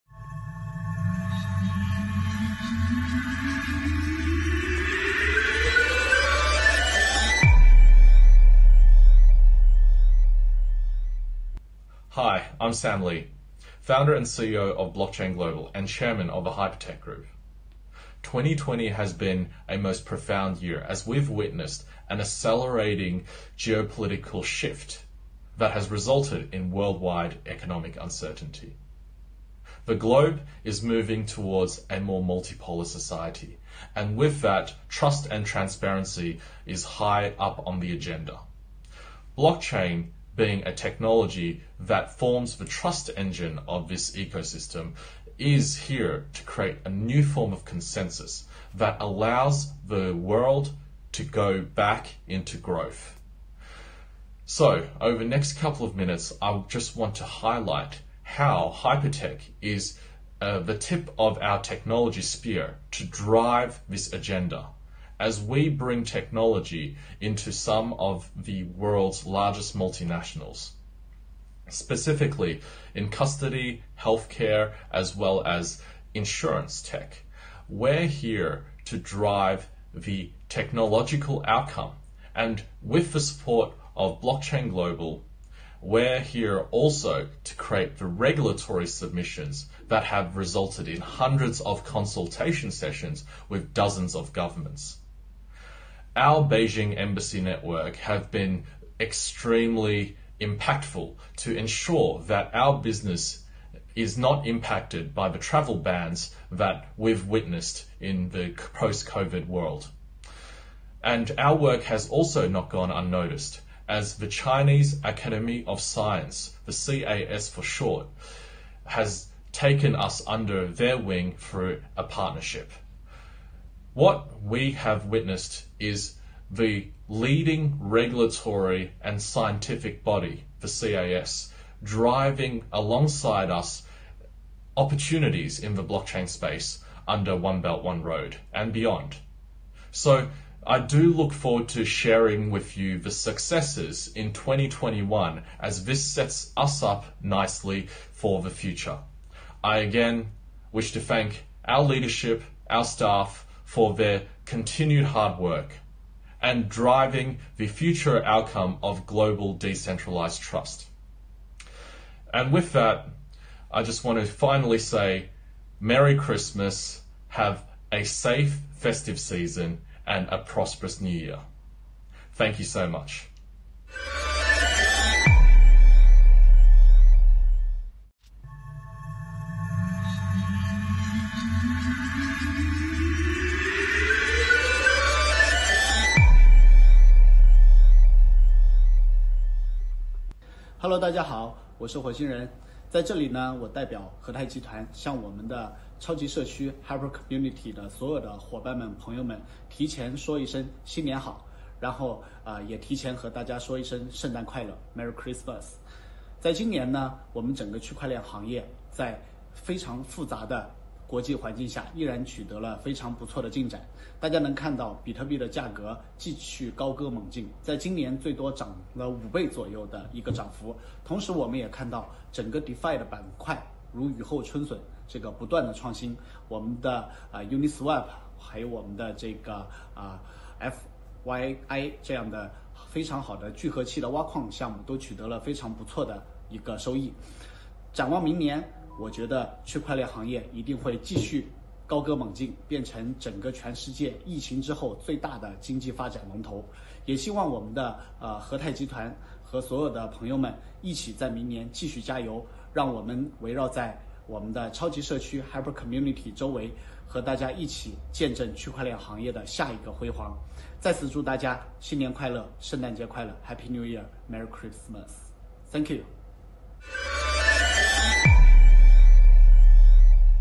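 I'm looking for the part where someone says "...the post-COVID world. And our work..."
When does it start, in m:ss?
1:48.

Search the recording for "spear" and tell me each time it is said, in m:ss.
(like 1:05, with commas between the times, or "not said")
1:02.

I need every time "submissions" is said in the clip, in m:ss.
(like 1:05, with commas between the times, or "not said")
1:28.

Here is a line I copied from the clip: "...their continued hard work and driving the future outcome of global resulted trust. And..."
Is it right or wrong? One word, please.
wrong.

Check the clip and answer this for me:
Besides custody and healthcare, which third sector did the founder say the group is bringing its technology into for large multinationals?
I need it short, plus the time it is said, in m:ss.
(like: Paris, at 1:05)
insurance tech, at 1:16.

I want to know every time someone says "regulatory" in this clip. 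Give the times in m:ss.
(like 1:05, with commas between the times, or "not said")
1:28, 2:07.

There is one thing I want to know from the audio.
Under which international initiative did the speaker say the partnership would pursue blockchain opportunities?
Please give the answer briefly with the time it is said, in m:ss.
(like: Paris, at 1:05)
One Belt One Road, at 2:17.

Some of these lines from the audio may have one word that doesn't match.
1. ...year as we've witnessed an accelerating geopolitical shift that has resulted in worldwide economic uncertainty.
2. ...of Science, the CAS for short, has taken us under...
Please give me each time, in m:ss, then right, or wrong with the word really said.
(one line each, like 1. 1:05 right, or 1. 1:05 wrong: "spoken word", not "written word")
1. 0:20 right
2. 1:55 right.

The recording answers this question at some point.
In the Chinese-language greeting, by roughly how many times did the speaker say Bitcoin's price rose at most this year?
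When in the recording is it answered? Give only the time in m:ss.
3:39.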